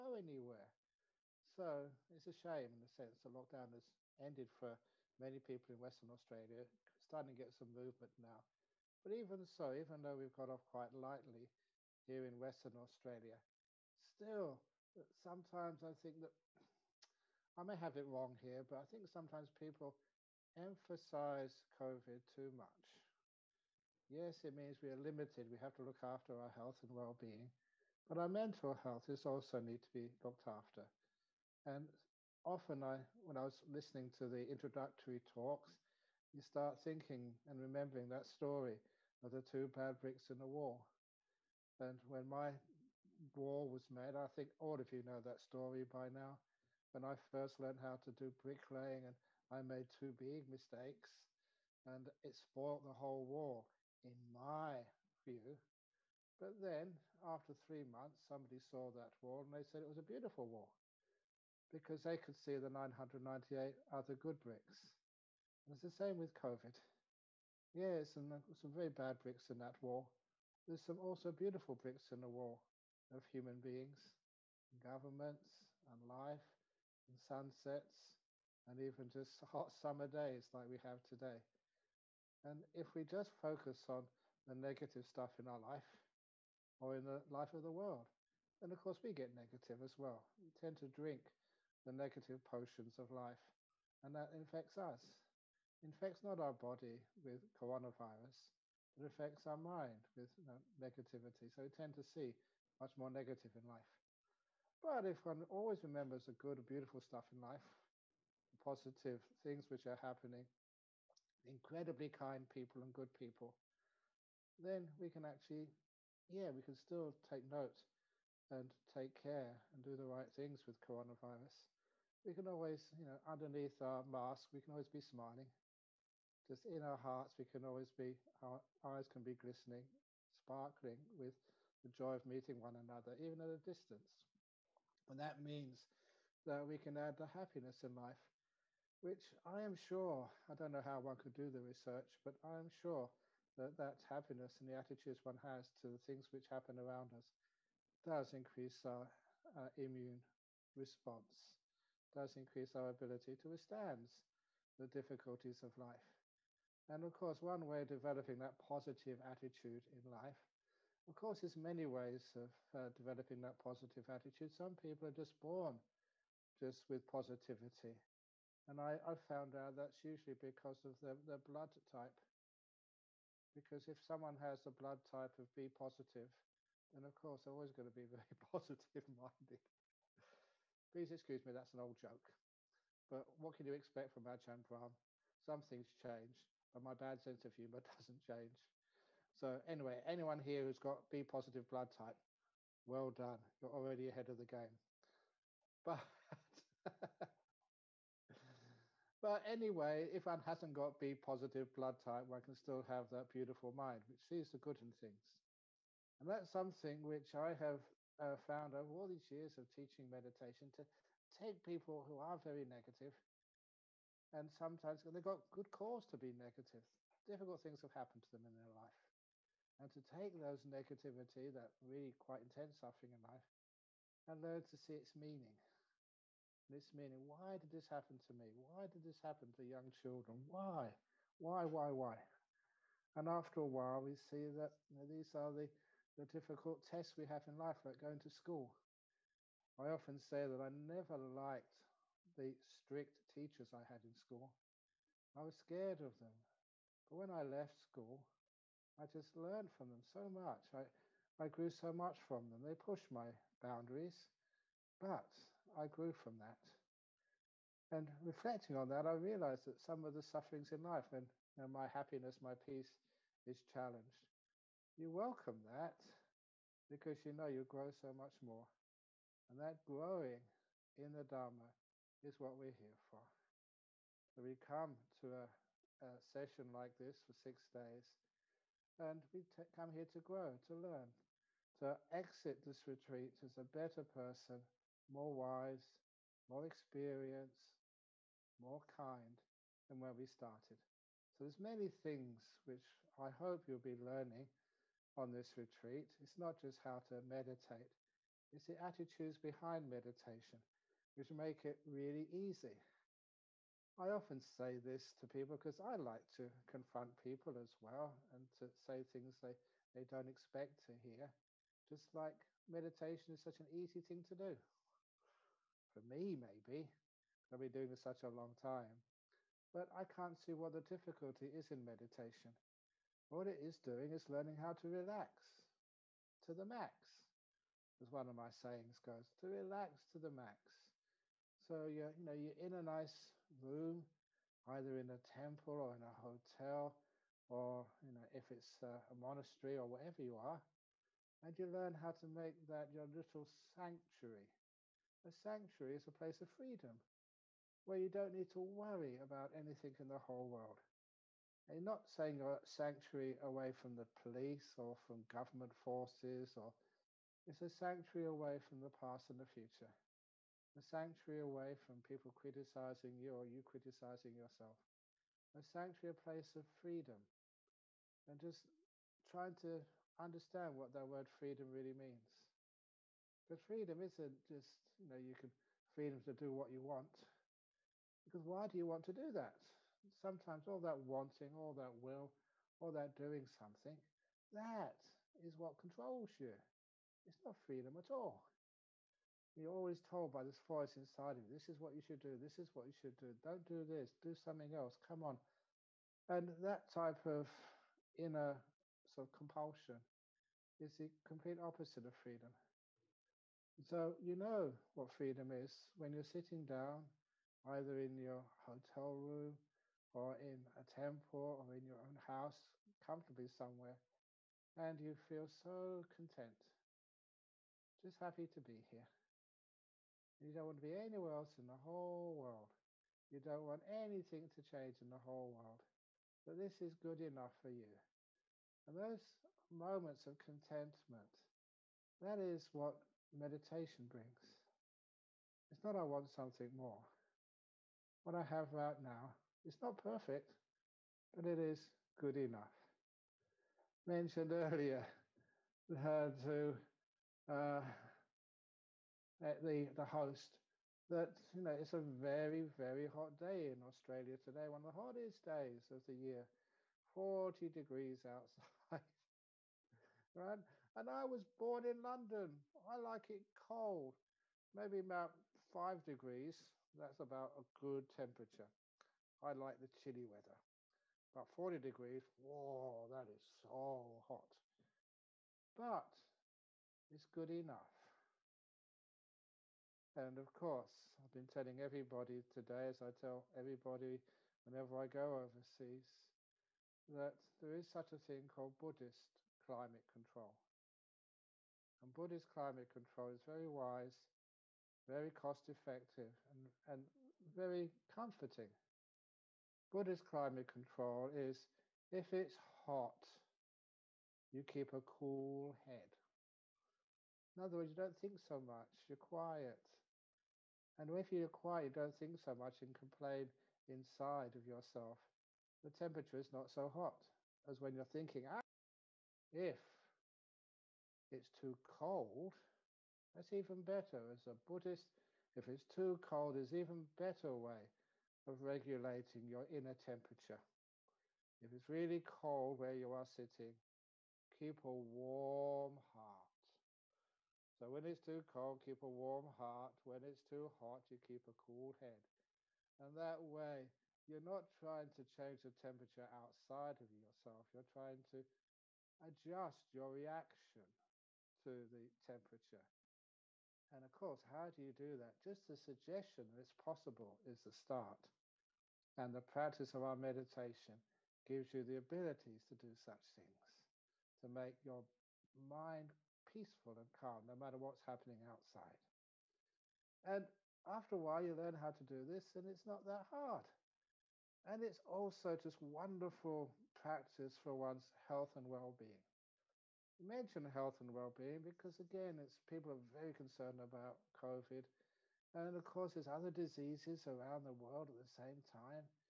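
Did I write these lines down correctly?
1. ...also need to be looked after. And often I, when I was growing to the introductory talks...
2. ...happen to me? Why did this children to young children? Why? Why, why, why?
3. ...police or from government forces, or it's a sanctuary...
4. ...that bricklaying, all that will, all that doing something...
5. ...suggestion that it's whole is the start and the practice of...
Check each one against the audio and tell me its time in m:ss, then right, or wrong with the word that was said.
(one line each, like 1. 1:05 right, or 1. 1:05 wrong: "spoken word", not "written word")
1. 0:29 wrong: "listening", not "growing"
2. 3:47 wrong: "happen", not "children"
3. 5:54 right
4. 6:20 wrong: "wanting", not "bricklaying"
5. 9:15 wrong: "possible", not "whole".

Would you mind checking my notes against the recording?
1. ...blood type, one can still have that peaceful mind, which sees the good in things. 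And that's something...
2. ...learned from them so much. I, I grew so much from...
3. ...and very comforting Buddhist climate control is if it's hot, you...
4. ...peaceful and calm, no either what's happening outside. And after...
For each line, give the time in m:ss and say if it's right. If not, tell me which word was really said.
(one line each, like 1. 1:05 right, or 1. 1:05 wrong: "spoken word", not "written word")
1. 3:21 wrong: "beautiful", not "peaceful"
2. 4:09 right
3. 8:16 right
4. 9:26 wrong: "matter", not "either".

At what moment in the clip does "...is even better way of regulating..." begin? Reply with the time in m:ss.
8:46.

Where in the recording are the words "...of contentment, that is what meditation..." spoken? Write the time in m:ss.
7:10.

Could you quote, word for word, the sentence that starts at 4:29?
And that growing in the Dharma is what we're here for.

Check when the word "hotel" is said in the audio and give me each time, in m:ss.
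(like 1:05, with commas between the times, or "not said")
5:36, 6:48.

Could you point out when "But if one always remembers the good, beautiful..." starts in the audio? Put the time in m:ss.
1:44.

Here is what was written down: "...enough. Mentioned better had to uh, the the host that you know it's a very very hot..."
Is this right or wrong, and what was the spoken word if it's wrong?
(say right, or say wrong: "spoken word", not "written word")
wrong: "earlier", not "better".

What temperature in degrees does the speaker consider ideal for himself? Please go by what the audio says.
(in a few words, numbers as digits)
5.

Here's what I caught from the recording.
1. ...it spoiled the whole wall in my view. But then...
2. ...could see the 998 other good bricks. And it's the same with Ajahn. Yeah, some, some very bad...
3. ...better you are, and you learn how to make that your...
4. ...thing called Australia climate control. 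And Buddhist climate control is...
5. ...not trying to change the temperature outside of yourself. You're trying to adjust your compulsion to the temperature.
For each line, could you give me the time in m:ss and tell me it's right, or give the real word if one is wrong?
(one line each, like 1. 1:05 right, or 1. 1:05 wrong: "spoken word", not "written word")
1. 0:52 right
2. 1:02 wrong: "COVID", not "Ajahn"
3. 5:39 wrong: "wherever", not "better"
4. 8:08 wrong: "Buddhist", not "Australia"
5. 9:04 wrong: "reaction", not "compulsion".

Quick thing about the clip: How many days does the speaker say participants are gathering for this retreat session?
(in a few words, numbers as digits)
6.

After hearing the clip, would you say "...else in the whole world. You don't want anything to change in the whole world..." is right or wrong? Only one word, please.
right.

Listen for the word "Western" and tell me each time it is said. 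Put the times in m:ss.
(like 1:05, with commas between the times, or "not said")
0:05, 0:12.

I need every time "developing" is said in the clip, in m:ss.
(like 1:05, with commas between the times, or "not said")
2:37, 2:42.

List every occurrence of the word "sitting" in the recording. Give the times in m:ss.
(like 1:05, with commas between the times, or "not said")
6:46, 8:53.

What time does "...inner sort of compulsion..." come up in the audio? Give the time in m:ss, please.
6:38.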